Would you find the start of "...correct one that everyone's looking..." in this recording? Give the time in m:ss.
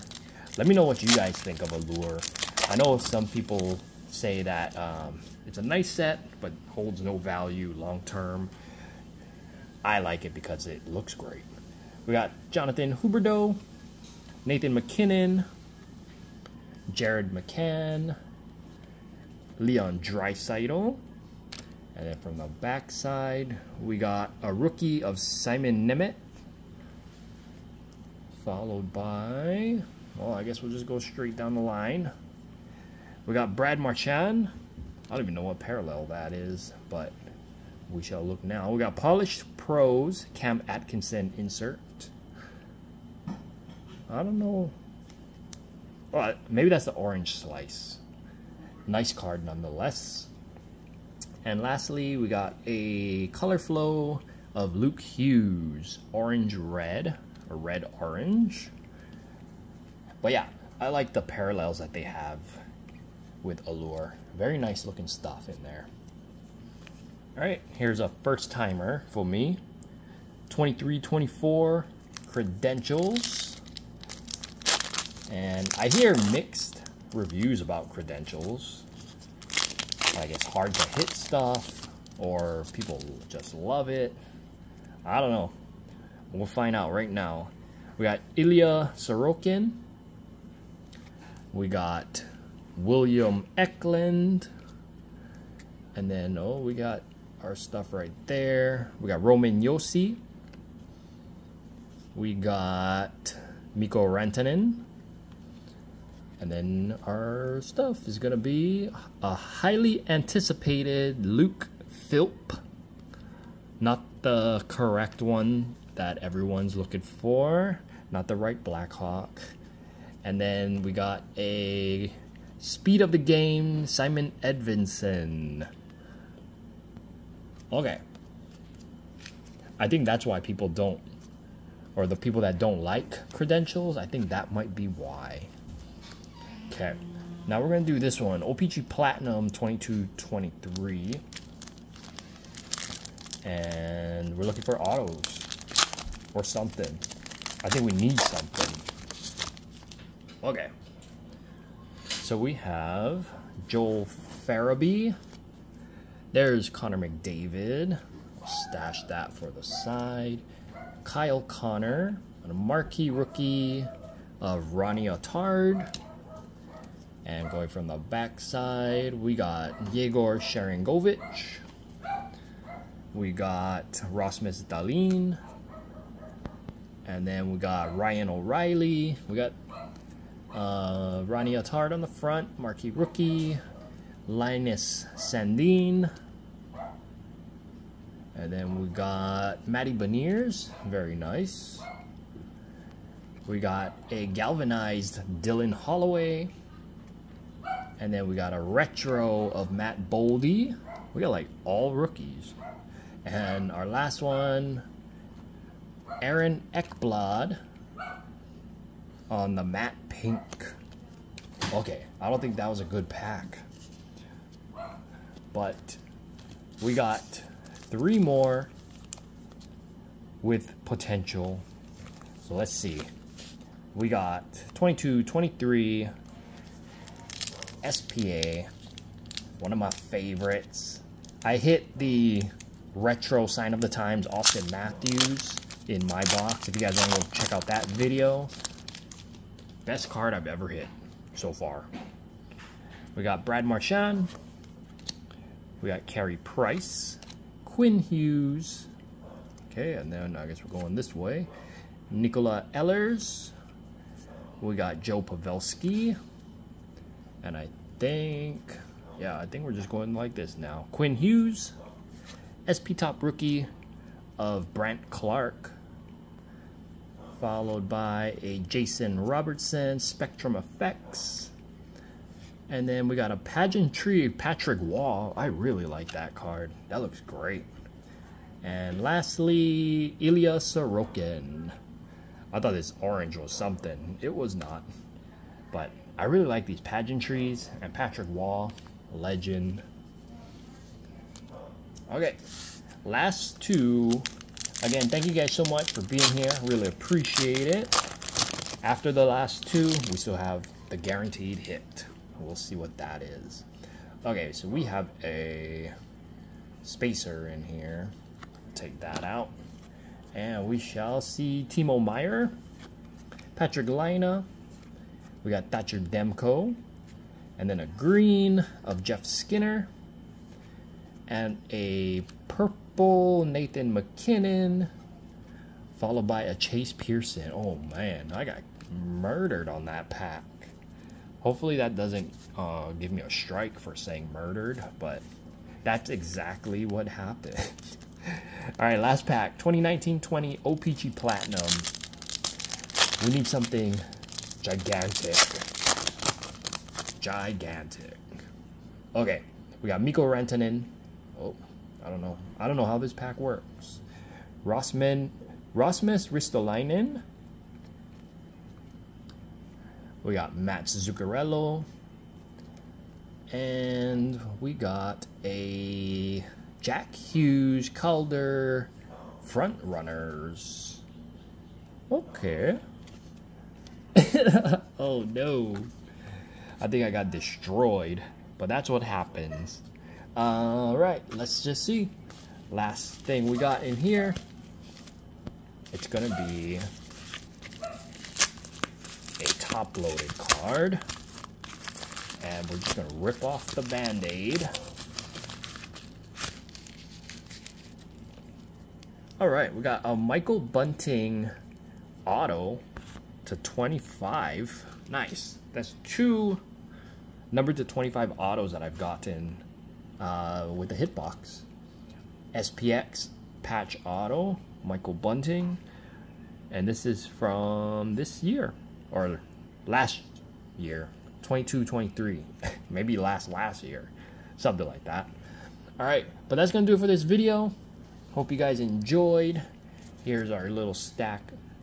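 1:54.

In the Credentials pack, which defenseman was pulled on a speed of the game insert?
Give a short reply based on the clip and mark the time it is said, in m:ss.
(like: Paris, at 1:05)
Simon Edvinsson, at 2:03.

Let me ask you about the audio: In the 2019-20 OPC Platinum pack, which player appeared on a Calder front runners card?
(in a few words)
Jack Hughes.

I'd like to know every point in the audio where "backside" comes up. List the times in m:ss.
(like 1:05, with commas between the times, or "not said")
0:22, 2:47.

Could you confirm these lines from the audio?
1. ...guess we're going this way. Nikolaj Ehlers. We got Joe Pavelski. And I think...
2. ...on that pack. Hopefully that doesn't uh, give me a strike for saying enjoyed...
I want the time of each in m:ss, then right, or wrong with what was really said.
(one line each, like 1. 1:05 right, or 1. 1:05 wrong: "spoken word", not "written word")
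1. 4:10 right
2. 5:29 wrong: "murdered", not "enjoyed".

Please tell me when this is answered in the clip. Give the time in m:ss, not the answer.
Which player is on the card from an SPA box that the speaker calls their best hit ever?
3:54.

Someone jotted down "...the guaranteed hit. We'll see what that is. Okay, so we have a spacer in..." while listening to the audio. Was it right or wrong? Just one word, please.
right.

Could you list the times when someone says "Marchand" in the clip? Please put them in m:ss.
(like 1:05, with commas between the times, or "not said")
0:33, 4:03.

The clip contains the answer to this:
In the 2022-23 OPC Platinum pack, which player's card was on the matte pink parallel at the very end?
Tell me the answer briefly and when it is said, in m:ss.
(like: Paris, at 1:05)
Aaron Ekblad, at 3:26.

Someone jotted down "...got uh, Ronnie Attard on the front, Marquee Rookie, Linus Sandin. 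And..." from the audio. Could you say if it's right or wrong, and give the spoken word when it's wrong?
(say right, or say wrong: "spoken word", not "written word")
right.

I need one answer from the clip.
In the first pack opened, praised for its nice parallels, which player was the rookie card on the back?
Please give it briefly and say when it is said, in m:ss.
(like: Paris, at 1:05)
Simon Nemec, at 0:25.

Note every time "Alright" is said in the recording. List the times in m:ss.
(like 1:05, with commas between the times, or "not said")
6:20, 6:39.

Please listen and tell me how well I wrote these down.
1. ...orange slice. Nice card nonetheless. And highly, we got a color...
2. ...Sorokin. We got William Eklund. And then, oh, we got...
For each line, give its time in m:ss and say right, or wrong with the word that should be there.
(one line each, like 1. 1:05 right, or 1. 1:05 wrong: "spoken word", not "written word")
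1. 0:46 wrong: "lastly", not "highly"
2. 1:28 right.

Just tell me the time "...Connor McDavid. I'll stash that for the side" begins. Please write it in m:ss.
2:36.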